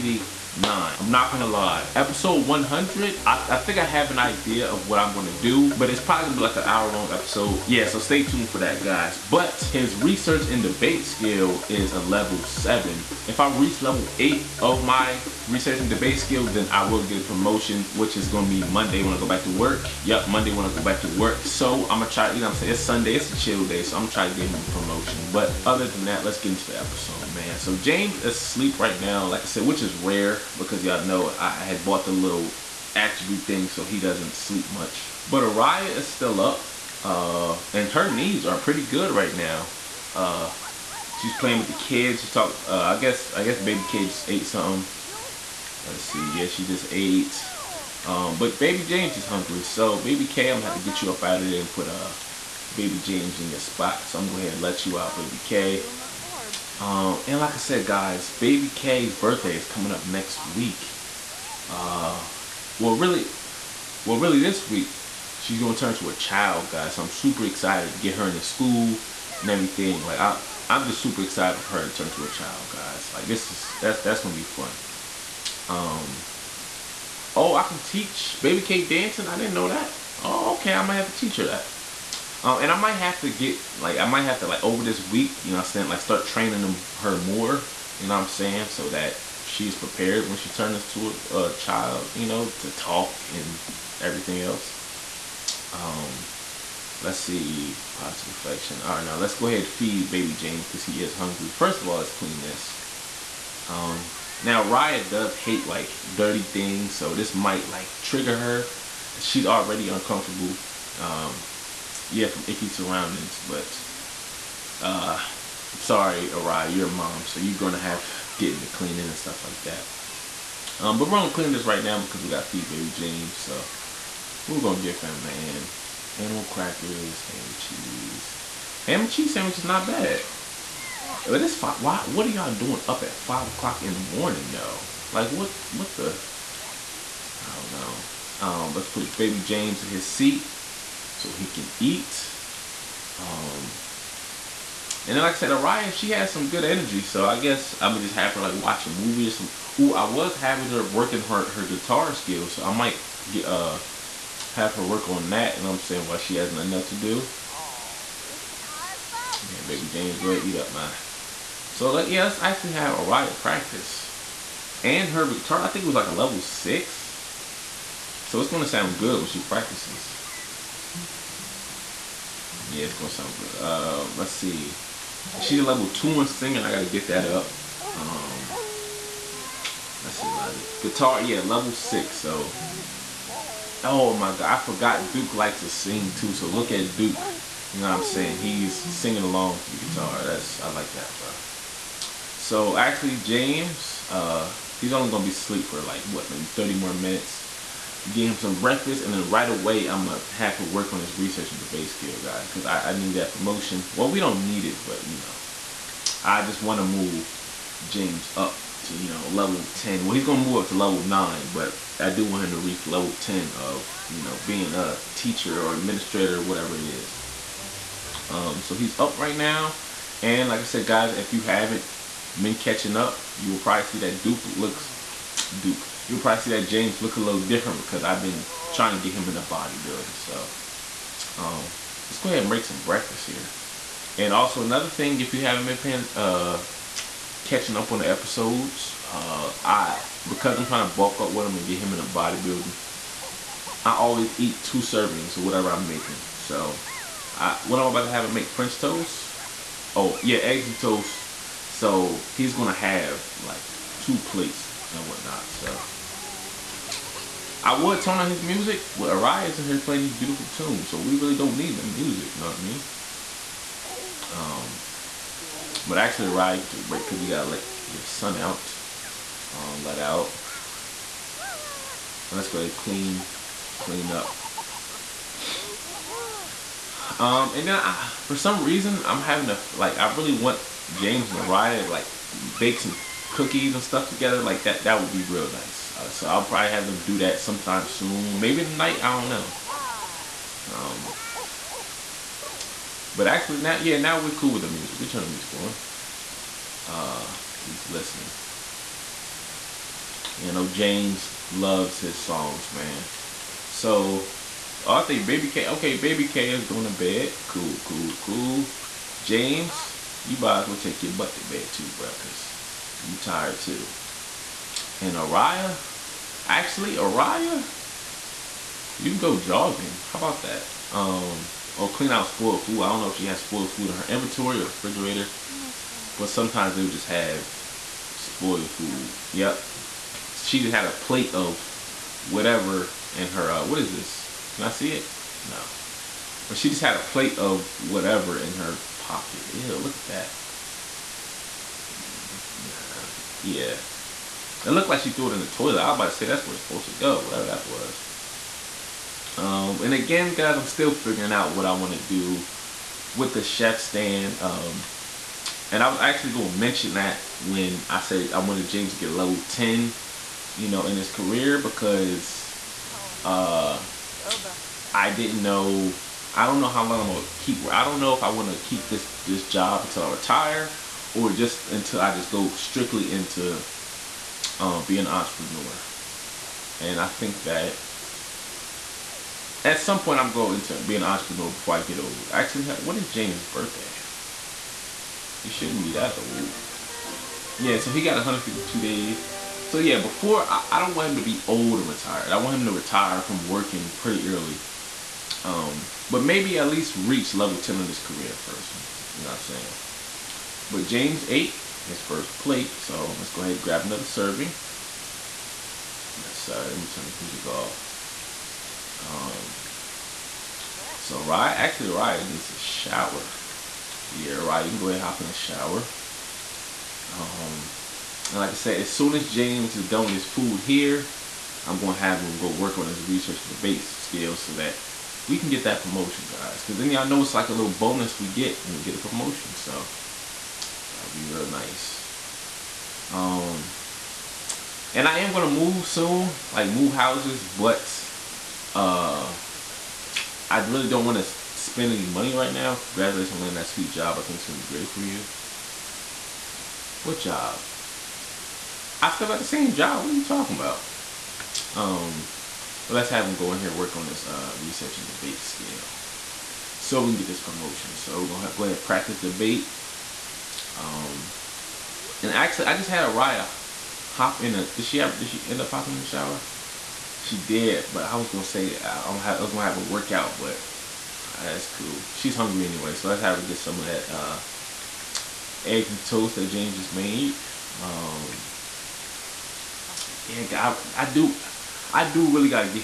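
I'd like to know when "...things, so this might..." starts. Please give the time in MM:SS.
01:46.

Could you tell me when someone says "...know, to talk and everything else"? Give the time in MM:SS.
01:32.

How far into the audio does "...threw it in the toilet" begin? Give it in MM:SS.
05:45.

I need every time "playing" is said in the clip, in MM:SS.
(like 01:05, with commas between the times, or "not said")
00:41, 04:19.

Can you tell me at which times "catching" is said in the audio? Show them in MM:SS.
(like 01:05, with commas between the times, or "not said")
03:42, 03:57.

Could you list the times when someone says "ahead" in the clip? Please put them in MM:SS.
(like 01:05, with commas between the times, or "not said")
00:54, 01:39, 02:40, 03:52, 04:32, 06:43, 06:54, 07:38.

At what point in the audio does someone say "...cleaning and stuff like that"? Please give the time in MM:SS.
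01:58.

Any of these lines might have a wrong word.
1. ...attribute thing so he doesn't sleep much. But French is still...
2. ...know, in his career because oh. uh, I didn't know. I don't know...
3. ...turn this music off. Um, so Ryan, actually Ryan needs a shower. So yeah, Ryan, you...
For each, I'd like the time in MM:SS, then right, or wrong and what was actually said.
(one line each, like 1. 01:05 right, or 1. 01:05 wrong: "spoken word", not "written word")
1. 00:32 wrong: "Araya", not "French"
2. 06:00 right
3. 06:46 right.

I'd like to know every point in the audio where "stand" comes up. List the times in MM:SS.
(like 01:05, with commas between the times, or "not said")
05:53.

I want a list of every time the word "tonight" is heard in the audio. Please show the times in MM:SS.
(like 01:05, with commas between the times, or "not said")
04:48.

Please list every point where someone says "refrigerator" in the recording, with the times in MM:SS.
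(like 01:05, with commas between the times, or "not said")
05:24.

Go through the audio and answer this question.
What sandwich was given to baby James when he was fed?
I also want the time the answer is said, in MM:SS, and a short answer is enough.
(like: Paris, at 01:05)
Ham and cheese, at 02:08.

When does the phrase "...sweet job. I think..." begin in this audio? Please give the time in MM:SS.
07:23.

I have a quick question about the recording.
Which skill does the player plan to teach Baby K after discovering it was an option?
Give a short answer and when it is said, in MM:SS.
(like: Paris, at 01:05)
Dancing, at 01:18.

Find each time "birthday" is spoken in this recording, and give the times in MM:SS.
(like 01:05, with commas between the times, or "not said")
00:59, 06:23.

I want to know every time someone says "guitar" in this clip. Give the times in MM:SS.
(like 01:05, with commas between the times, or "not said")
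02:31, 02:45, 03:00, 03:09.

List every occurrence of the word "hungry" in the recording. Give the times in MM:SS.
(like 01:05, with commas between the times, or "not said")
00:49, 01:41, 07:52.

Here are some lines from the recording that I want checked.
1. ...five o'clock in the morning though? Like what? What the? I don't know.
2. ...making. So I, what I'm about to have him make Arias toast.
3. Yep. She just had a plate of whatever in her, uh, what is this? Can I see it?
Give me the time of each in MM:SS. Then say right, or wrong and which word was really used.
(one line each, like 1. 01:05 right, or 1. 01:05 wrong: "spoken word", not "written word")
1. 02:13 right
2. 04:05 wrong: "French", not "Arias"
3. 05:29 right.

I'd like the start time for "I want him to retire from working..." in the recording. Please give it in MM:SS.
06:32.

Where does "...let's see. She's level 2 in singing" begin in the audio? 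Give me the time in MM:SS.
02:54.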